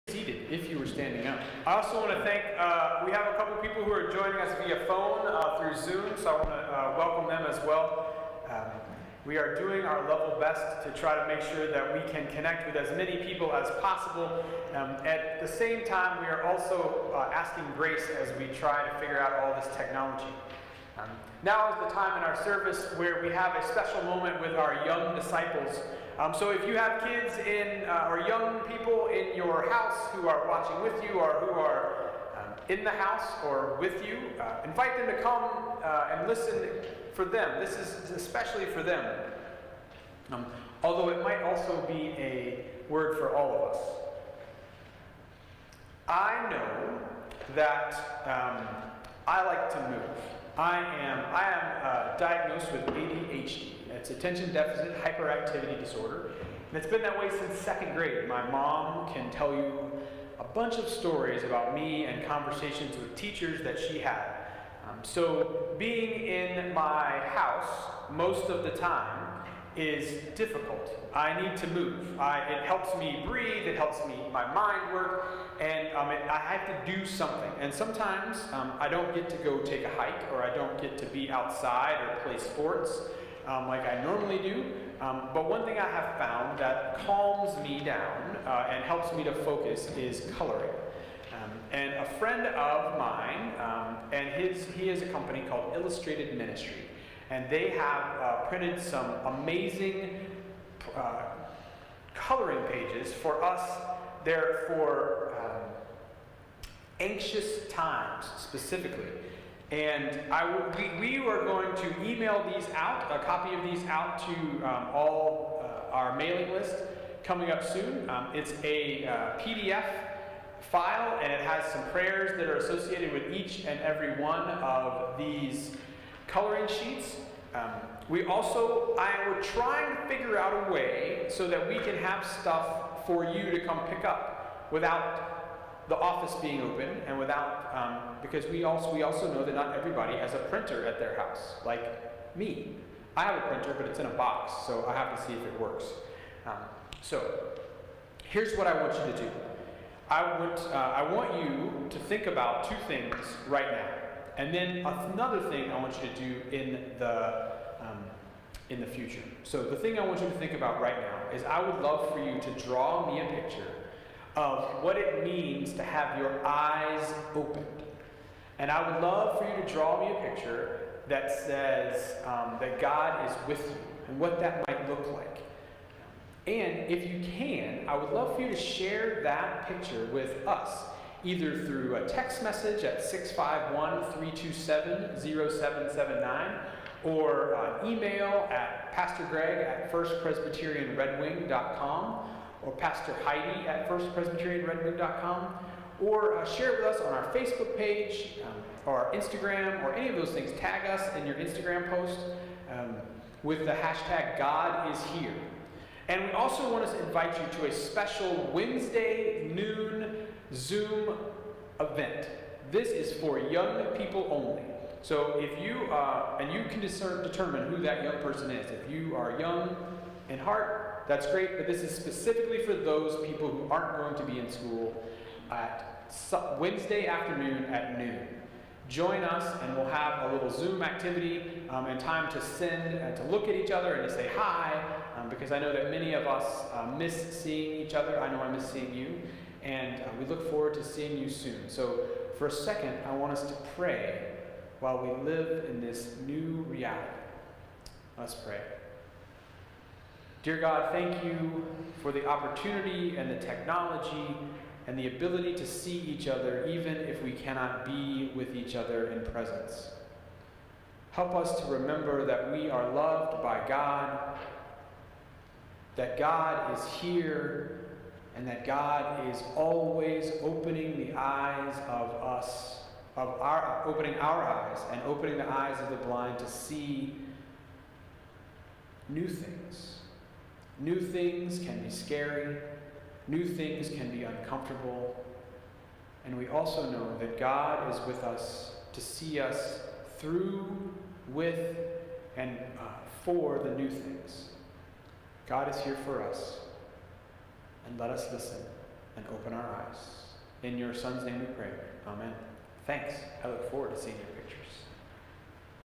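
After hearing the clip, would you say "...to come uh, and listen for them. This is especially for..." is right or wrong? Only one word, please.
right.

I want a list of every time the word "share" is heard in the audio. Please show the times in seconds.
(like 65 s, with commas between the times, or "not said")
178 s, 196 s.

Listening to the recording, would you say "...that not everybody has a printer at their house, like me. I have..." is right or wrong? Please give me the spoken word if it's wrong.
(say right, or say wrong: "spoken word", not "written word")
right.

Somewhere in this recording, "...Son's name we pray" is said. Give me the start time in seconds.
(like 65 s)
300 s.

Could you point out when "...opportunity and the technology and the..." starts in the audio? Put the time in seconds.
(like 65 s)
252 s.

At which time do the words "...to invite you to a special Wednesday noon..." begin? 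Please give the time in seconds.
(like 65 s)
206 s.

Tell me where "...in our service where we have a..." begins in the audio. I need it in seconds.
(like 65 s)
22 s.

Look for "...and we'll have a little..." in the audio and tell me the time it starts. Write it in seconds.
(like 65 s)
229 s.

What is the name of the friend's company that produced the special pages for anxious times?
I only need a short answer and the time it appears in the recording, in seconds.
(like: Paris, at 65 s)
Illustrated Ministry, at 95 s.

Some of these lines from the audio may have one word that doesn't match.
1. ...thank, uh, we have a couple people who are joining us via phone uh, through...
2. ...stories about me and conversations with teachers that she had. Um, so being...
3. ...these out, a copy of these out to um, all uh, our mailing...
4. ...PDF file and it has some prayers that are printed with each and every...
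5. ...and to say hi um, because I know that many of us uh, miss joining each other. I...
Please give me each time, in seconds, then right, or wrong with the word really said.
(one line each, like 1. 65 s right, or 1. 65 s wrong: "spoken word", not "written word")
1. 2 s right
2. 60 s right
3. 112 s right
4. 119 s wrong: "associated", not "printed"
5. 233 s wrong: "seeing", not "joining".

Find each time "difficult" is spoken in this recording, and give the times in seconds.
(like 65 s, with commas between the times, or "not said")
70 s.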